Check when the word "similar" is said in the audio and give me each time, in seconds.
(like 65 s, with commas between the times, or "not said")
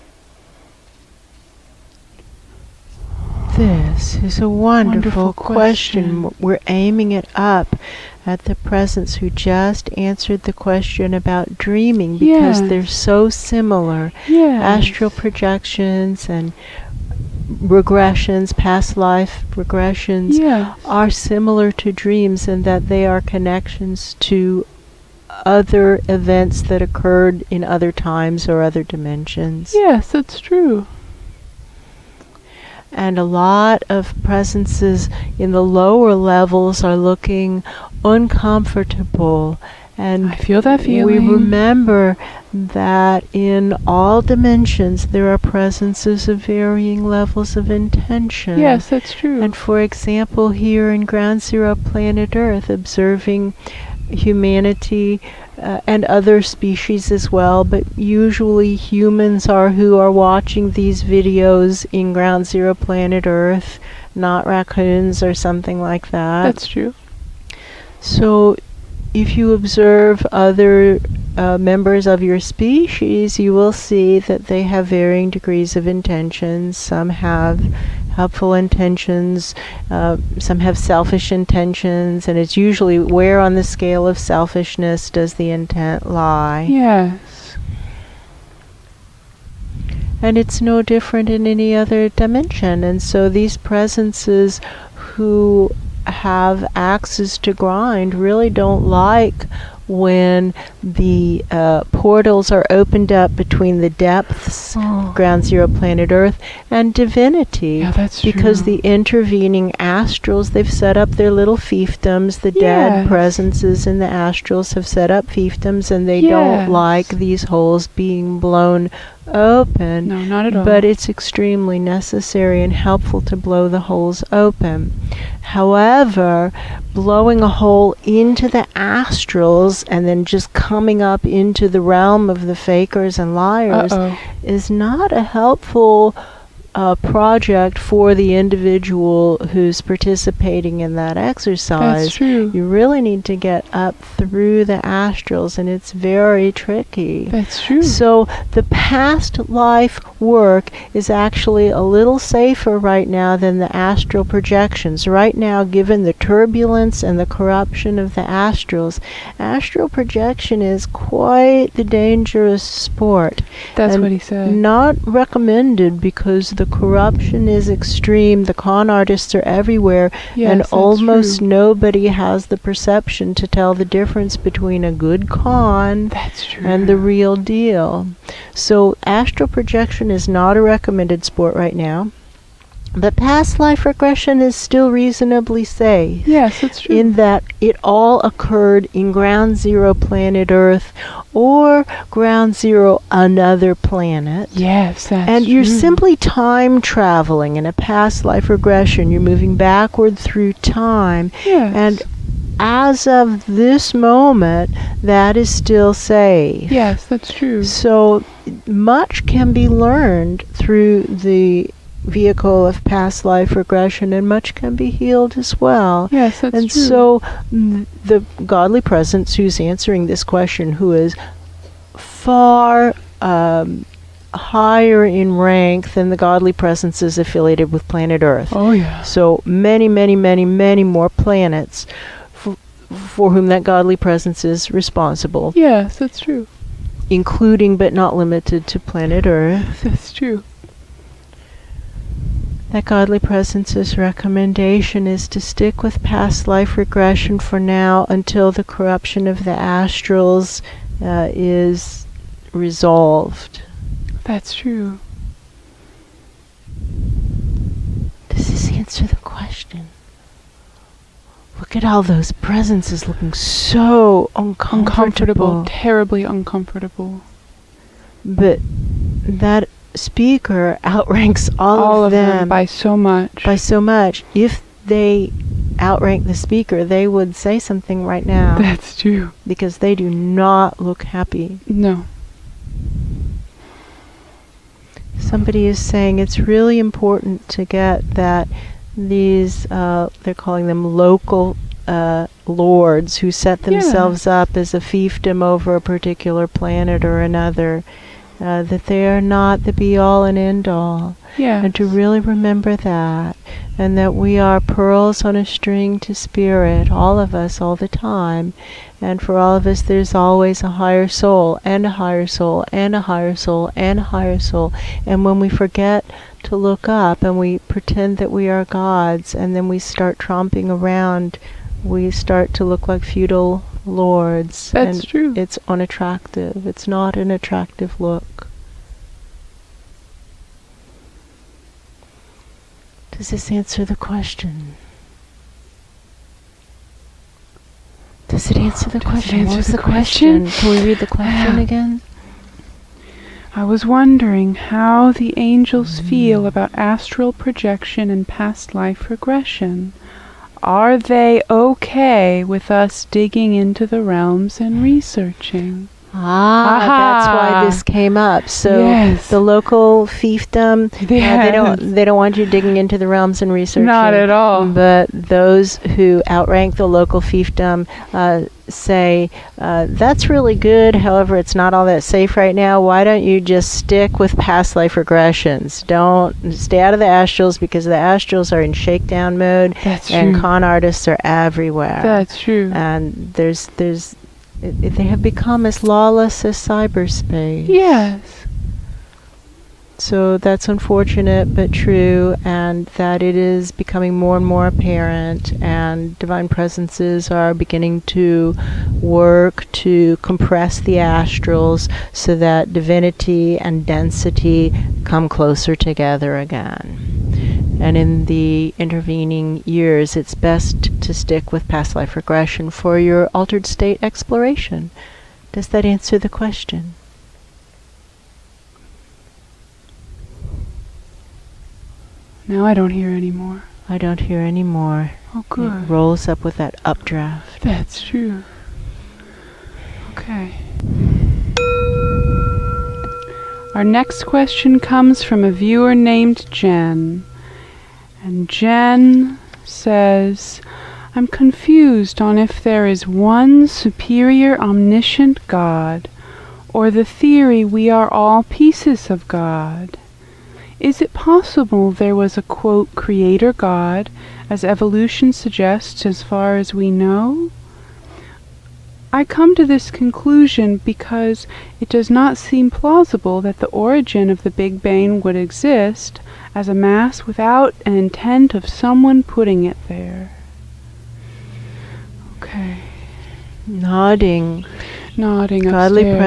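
13 s, 21 s.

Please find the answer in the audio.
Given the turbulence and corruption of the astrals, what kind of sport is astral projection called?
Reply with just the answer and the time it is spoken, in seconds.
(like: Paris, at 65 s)
dangerous sport, at 161 s.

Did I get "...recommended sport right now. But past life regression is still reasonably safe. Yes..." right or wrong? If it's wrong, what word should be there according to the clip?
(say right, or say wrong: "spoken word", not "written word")
right.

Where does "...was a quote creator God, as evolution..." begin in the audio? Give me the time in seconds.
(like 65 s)
452 s.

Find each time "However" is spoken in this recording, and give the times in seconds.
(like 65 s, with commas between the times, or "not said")
125 s, 370 s.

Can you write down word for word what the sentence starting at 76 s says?
Some have helpful intentions, uh, some have selfish intentions, and it's usually where on the scale of selfishness does the intent lie.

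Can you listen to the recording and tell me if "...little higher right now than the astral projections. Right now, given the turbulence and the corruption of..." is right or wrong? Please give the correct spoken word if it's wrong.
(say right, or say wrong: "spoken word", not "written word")
wrong: "safer", not "higher".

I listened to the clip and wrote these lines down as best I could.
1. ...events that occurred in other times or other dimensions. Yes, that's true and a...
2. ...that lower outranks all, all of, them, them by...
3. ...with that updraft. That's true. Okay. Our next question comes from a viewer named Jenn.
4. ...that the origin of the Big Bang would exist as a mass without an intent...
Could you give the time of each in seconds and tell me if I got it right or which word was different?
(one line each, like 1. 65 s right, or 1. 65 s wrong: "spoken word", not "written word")
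1. 26 s right
2. 269 s wrong: "speaker", not "lower"
3. 426 s right
4. 463 s right.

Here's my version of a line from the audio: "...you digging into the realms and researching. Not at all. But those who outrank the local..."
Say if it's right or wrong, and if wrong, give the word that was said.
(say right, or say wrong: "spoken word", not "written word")
right.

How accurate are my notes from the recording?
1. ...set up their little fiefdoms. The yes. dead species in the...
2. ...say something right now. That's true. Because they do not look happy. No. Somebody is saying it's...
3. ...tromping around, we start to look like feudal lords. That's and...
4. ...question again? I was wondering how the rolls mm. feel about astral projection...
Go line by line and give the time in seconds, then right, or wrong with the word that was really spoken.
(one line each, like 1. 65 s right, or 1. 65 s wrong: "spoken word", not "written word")
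1. 110 s wrong: "presences", not "species"
2. 277 s right
3. 320 s right
4. 341 s wrong: "angels", not "rolls".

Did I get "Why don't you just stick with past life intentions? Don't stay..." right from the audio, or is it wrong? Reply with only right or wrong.
wrong.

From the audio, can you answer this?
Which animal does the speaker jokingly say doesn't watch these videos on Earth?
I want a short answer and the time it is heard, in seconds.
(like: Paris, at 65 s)
raccoons, at 64 s.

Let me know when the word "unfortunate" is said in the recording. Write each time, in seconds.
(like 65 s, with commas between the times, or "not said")
390 s.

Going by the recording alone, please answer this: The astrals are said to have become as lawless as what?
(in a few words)
cyberspace.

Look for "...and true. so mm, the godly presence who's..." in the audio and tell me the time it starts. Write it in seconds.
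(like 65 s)
216 s.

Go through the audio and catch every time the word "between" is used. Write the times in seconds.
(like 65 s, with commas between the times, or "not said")
103 s, 174 s.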